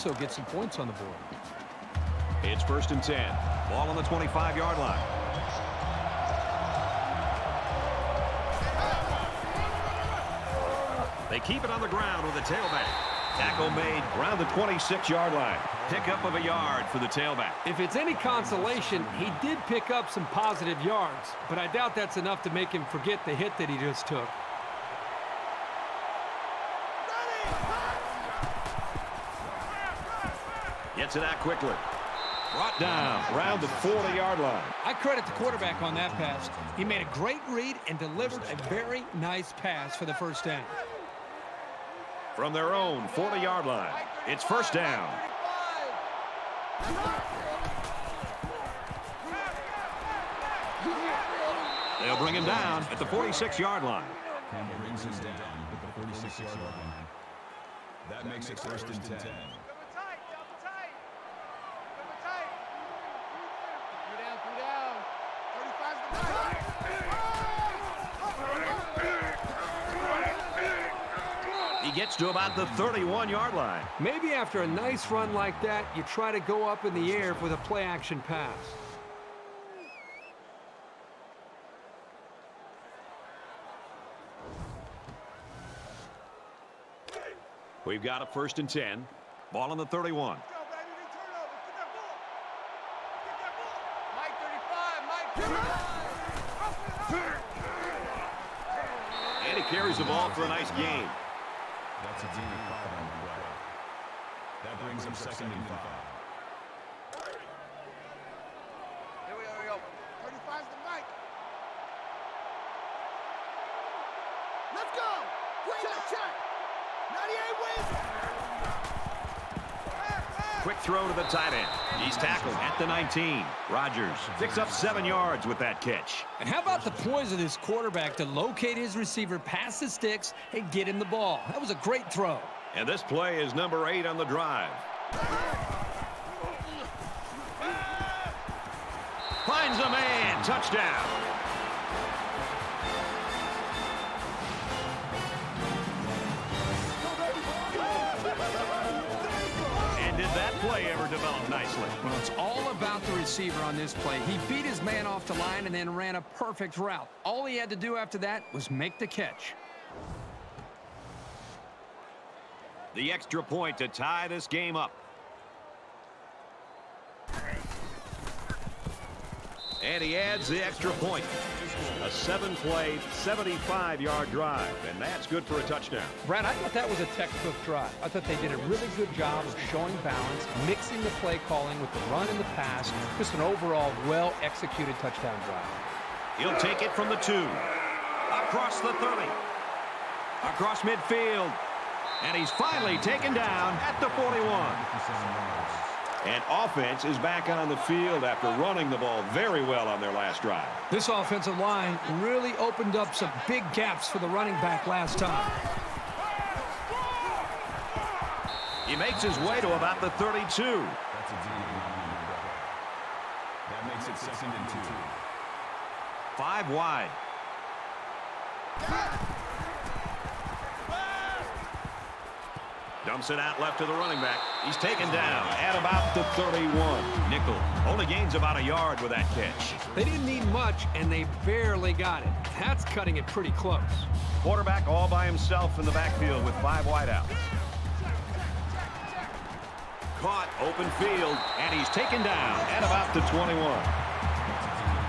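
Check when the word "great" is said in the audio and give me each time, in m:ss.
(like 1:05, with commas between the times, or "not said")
0:37, 2:11.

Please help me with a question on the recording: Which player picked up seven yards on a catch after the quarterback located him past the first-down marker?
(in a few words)
Rodgers.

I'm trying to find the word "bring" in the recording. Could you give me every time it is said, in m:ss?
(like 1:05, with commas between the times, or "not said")
0:52, 1:44.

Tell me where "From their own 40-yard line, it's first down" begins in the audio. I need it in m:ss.
0:42.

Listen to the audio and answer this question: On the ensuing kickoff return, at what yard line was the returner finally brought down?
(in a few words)
41.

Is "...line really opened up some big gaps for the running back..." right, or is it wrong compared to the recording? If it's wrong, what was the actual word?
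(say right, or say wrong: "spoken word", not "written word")
right.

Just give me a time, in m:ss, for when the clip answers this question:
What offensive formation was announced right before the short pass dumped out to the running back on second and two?
3:36.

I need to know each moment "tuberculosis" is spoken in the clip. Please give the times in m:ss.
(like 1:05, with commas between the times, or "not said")
not said.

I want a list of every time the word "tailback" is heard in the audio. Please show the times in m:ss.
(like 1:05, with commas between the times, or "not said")
0:12, 0:17.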